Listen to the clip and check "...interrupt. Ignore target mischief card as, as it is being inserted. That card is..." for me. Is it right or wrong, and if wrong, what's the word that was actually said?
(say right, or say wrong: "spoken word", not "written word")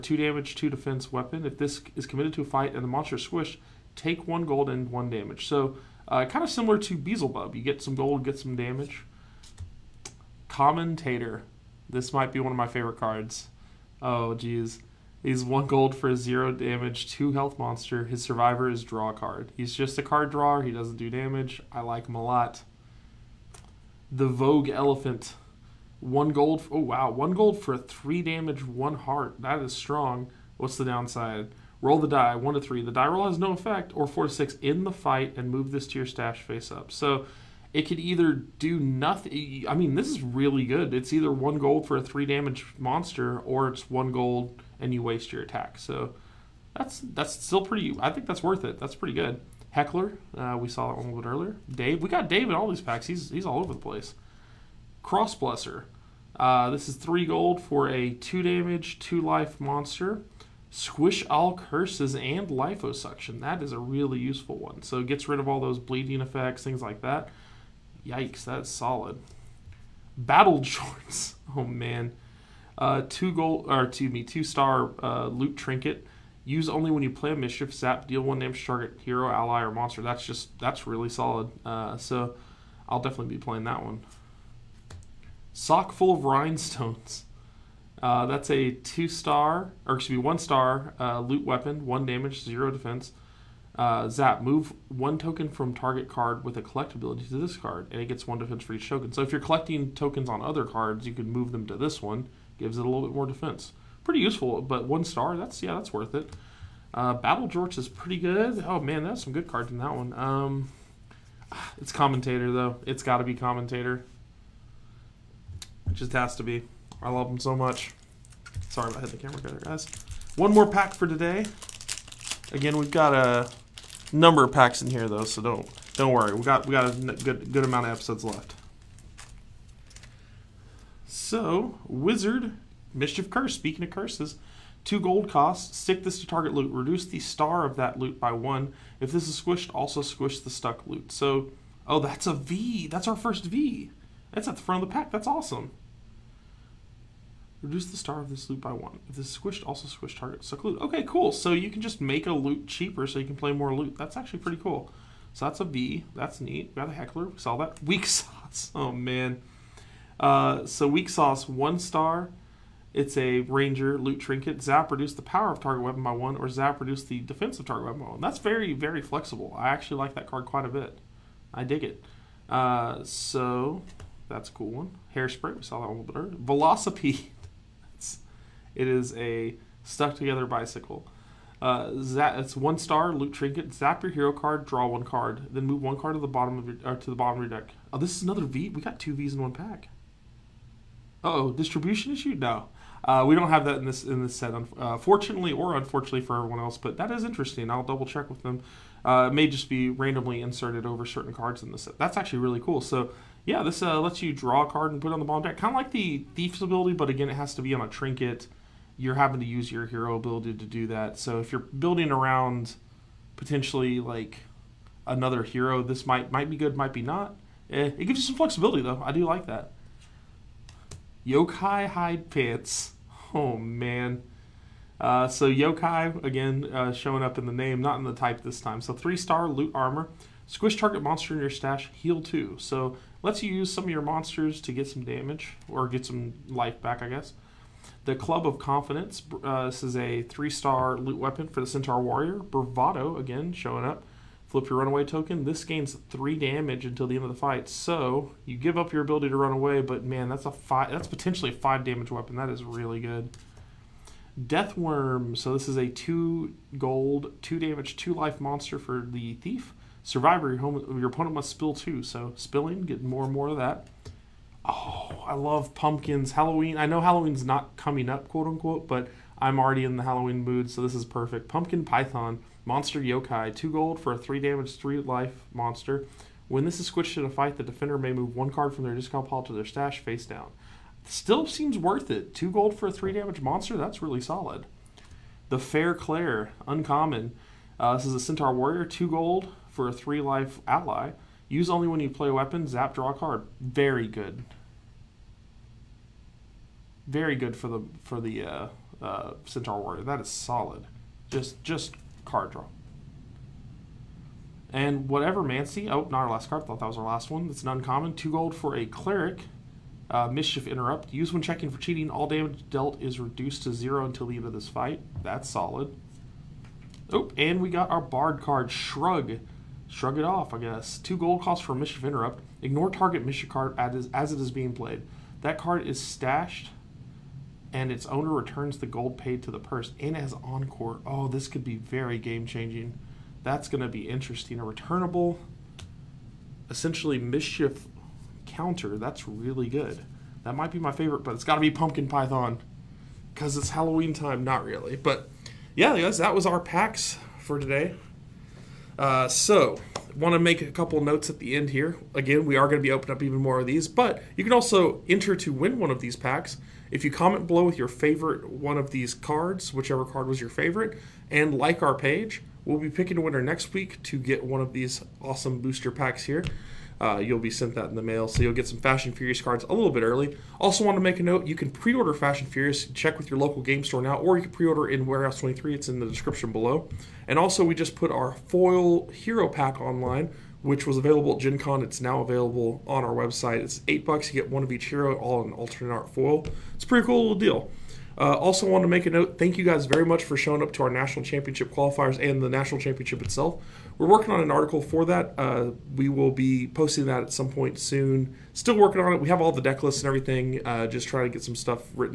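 wrong: "played", not "inserted".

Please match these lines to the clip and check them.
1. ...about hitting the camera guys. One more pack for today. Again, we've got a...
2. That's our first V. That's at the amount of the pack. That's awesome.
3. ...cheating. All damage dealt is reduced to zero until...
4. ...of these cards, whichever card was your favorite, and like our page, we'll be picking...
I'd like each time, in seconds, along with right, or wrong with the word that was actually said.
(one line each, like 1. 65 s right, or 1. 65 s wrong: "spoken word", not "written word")
1. 118 s right
2. 142 s wrong: "front", not "amount"
3. 311 s right
4. 358 s right.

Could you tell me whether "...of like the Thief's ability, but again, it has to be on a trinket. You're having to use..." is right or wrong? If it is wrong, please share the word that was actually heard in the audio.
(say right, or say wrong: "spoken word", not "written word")
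right.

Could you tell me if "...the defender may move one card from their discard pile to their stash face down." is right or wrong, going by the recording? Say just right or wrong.
right.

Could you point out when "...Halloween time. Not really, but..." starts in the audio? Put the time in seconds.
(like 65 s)
343 s.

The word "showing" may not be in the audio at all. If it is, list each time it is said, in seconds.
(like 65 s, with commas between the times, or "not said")
226 s, 243 s, 390 s.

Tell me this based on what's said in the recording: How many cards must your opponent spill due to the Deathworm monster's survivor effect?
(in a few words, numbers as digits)
2.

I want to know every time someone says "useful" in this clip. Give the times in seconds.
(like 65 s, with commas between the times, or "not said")
64 s, 104 s.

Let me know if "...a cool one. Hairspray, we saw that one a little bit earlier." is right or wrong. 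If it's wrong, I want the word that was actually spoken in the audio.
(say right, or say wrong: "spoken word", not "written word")
right.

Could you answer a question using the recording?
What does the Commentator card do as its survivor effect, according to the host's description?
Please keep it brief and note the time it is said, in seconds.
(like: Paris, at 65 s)
Draw card, at 18 s.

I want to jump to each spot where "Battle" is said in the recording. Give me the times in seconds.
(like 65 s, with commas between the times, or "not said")
70 s, 107 s.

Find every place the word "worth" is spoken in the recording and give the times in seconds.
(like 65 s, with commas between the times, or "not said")
48 s, 105 s, 281 s.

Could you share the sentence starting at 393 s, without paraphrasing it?
We're working on an article for that.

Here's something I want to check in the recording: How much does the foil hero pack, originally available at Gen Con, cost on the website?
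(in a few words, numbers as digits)
$8.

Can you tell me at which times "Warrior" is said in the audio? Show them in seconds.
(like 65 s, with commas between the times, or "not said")
242 s, 288 s, 299 s.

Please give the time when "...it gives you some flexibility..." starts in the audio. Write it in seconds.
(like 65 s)
217 s.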